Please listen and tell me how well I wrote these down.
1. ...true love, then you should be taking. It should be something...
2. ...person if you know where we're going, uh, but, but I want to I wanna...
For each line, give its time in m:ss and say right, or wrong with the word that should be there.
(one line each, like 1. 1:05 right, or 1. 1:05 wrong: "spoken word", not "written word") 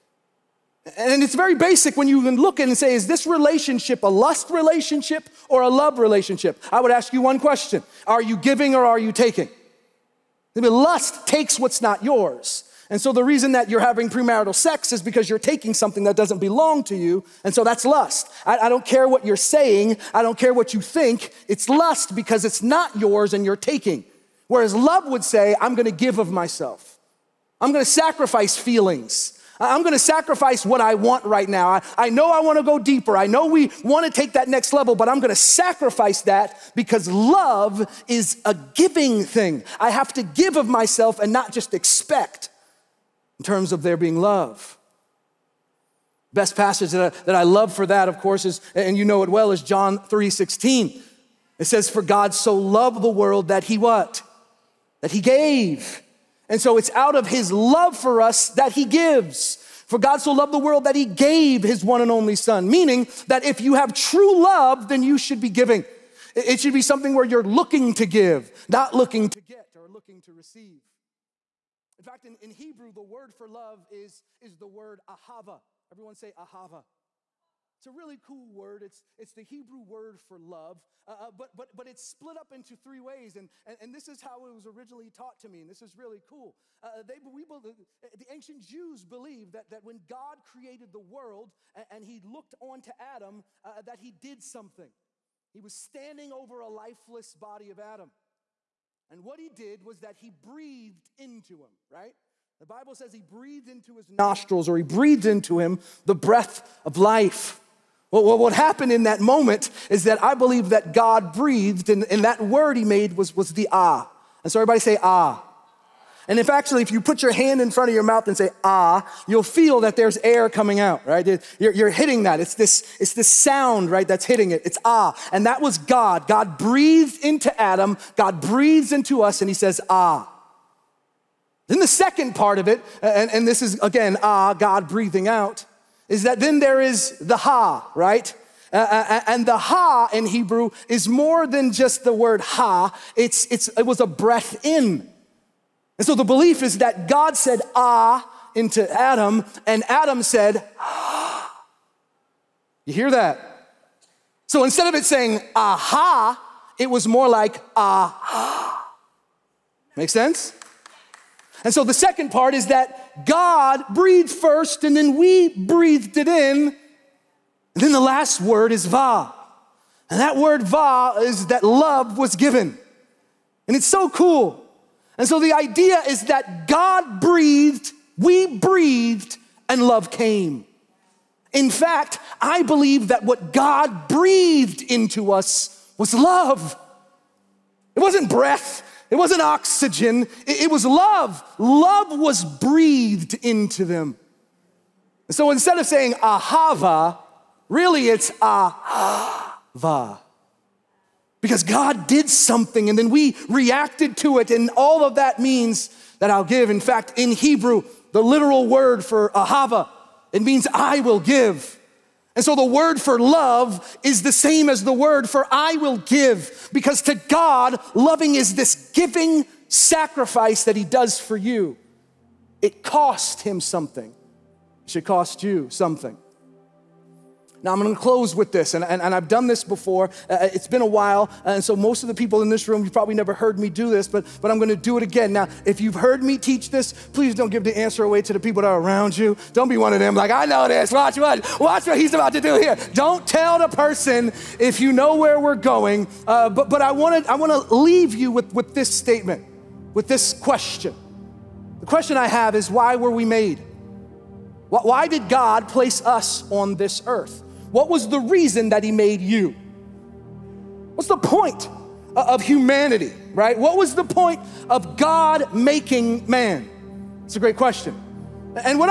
1. 1:03 wrong: "giving", not "taking"
2. 4:03 right.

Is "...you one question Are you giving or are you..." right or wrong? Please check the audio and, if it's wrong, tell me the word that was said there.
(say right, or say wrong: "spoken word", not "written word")
right.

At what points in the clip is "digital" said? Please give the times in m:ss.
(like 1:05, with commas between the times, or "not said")
not said.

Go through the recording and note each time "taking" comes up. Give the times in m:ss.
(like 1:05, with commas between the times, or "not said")
0:09, 0:15, 0:23.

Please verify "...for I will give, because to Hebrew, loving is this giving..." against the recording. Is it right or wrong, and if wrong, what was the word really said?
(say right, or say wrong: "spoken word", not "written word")
wrong: "God", not "Hebrew".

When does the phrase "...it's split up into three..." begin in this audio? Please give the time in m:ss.
1:21.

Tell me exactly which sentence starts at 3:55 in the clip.
Now, if you've heard me teach this, please don't give the answer away to the people that are around you.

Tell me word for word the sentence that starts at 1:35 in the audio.
He was standing over a lifeless body of Adam.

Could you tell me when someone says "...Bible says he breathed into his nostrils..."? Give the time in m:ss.
1:42.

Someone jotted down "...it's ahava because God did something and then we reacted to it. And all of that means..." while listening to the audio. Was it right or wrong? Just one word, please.
right.